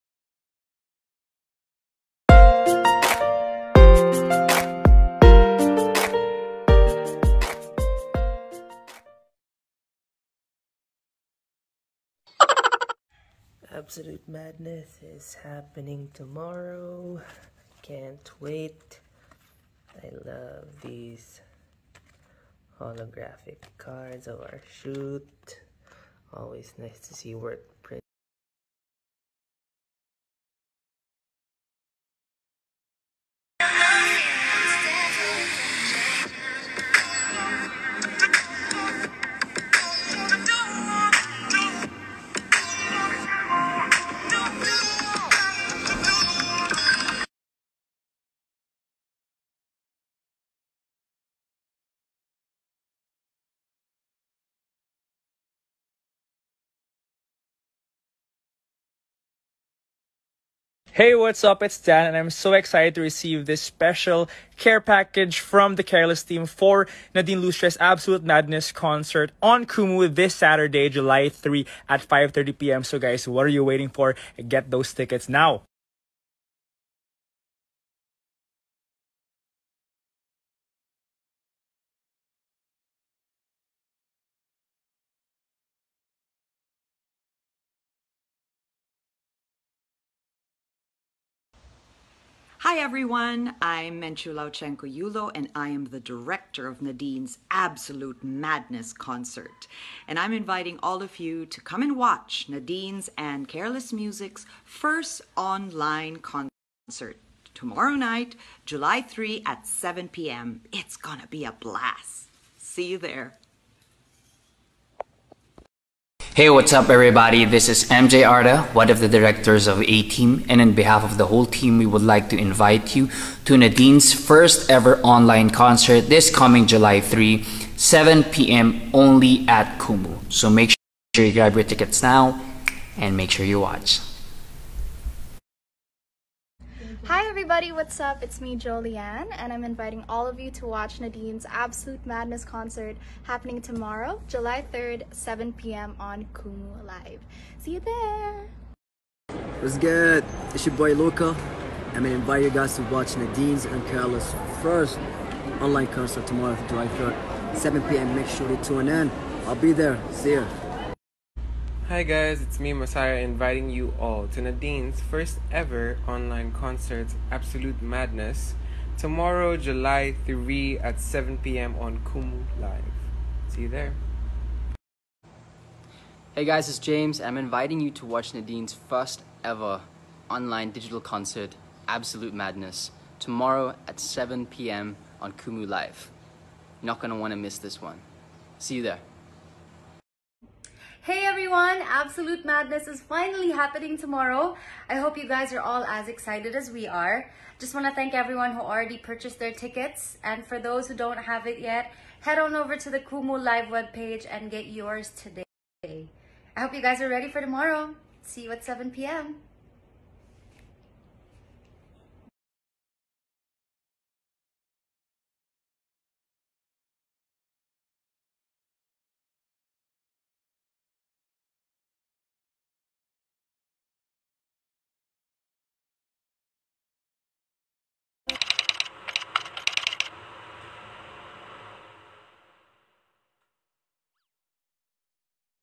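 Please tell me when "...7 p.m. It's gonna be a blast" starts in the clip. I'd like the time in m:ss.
1:49.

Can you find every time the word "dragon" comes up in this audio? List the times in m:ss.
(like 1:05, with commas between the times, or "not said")
not said.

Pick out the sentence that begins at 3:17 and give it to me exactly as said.
Just want to thank everyone who already purchased their tickets.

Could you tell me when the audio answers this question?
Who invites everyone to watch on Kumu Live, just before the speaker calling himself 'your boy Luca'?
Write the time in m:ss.
2:18.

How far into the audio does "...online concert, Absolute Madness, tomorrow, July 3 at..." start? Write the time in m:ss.
2:46.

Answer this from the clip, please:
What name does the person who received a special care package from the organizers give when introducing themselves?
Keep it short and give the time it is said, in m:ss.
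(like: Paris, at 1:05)
Dan, at 1:01.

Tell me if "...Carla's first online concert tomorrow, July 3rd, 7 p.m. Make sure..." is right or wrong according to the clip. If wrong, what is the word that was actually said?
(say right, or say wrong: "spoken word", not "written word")
right.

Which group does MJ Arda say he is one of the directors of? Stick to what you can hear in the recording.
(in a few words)
A Team.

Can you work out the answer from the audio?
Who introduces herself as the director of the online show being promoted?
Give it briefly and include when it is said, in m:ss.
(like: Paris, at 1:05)
Menchu Lauchengco Yulo, at 1:33.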